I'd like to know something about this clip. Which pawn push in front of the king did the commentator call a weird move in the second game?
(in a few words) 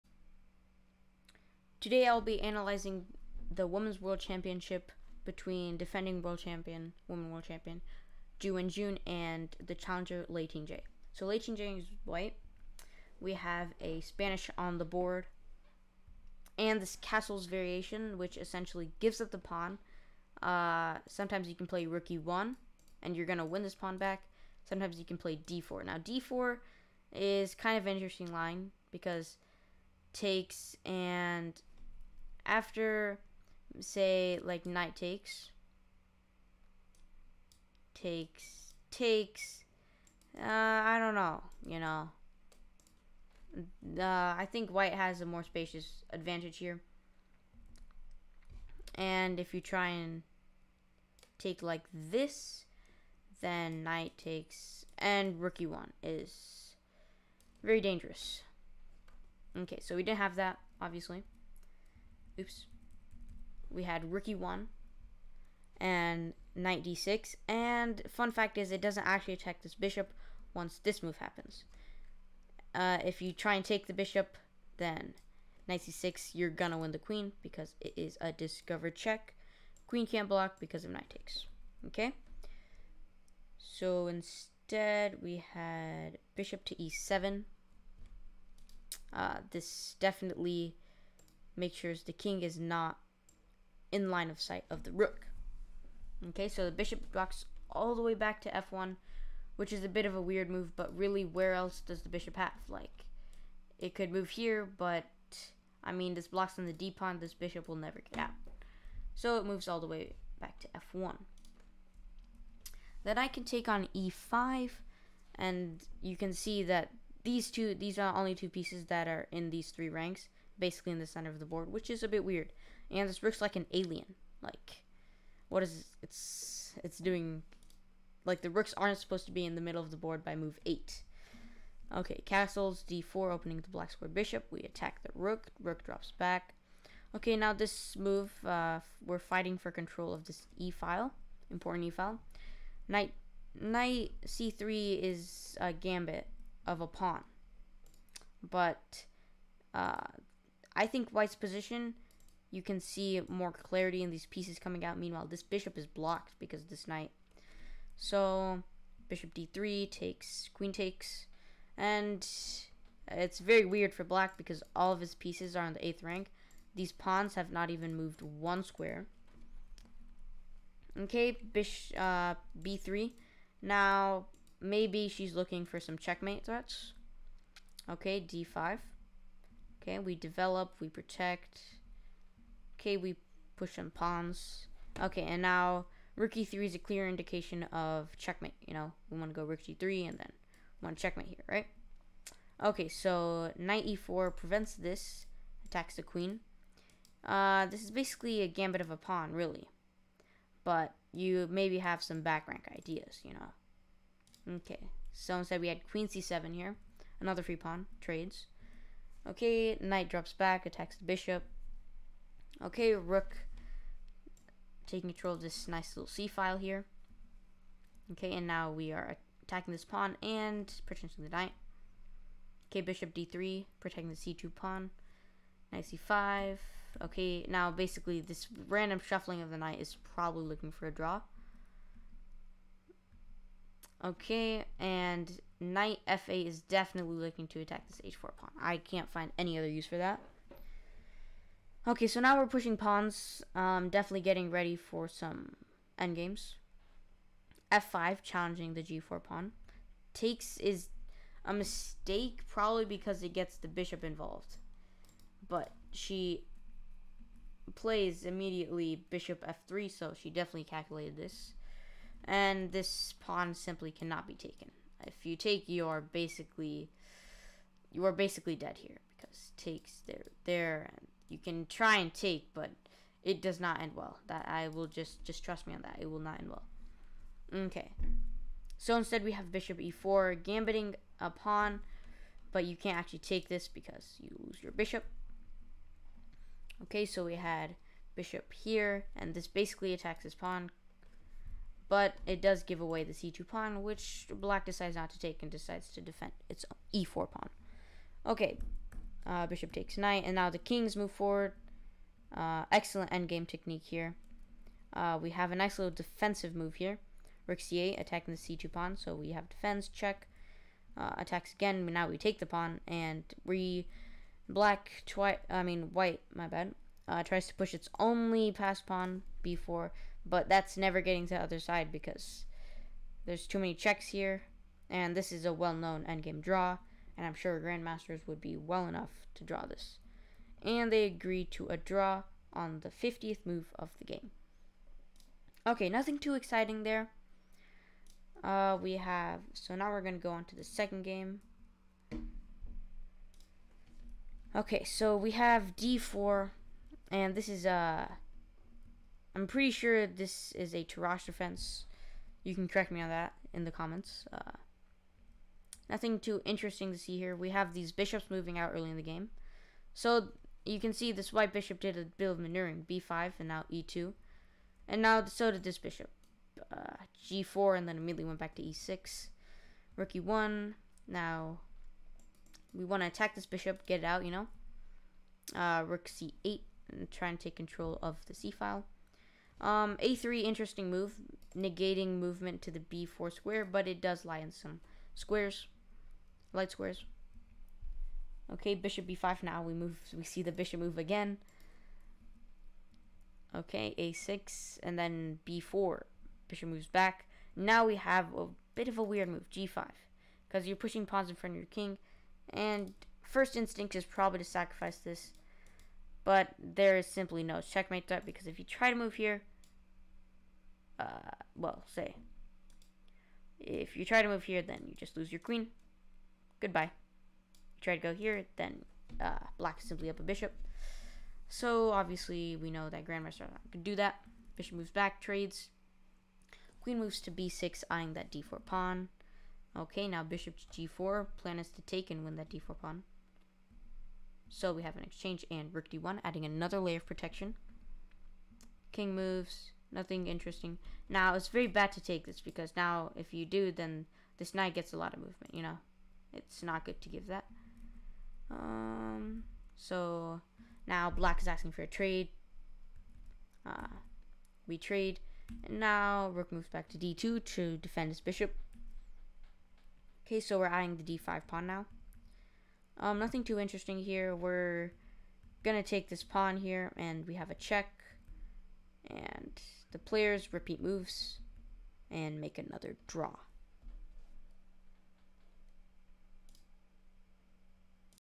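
g5.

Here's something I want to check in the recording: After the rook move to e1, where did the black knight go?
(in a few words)
knight d6.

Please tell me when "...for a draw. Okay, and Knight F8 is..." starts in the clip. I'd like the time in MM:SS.
03:50.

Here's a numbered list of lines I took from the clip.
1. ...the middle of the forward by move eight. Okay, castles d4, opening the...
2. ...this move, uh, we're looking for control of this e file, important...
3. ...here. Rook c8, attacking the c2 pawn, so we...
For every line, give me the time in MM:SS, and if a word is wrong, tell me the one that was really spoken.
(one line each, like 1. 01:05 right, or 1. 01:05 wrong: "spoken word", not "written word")
1. 02:09 wrong: "board", not "forward"
2. 02:17 wrong: "fighting", not "looking"
3. 05:06 right.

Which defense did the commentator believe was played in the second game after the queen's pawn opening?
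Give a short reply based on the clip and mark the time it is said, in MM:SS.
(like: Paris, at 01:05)
Tarrasch defense, at 05:50.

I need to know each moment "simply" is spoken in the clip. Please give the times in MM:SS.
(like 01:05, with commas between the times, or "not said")
04:23, 06:47, 06:59.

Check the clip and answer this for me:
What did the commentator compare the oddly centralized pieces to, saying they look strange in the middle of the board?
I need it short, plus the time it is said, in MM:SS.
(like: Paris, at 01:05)
an alien, at 02:03.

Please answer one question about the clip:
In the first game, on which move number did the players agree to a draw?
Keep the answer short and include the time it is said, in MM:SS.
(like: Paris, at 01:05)
50, at 05:32.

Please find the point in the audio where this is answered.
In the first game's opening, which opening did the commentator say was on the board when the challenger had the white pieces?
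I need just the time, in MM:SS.
00:14.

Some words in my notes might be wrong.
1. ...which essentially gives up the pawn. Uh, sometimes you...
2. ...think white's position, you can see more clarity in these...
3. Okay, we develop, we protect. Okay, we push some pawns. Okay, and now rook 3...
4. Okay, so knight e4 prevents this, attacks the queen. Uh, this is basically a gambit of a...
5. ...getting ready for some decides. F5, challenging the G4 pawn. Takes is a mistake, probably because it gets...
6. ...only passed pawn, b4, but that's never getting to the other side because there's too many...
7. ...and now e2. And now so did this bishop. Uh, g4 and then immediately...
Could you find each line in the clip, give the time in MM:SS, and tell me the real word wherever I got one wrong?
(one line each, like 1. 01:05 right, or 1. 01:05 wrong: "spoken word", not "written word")
1. 00:18 right
2. 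02:30 right
3. 02:59 right
4. 03:12 right
5. 04:04 wrong: "endgames", not "decides"
6. 05:17 right
7. 06:03 right.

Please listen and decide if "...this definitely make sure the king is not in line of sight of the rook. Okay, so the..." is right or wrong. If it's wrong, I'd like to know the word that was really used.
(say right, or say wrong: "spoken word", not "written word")
right.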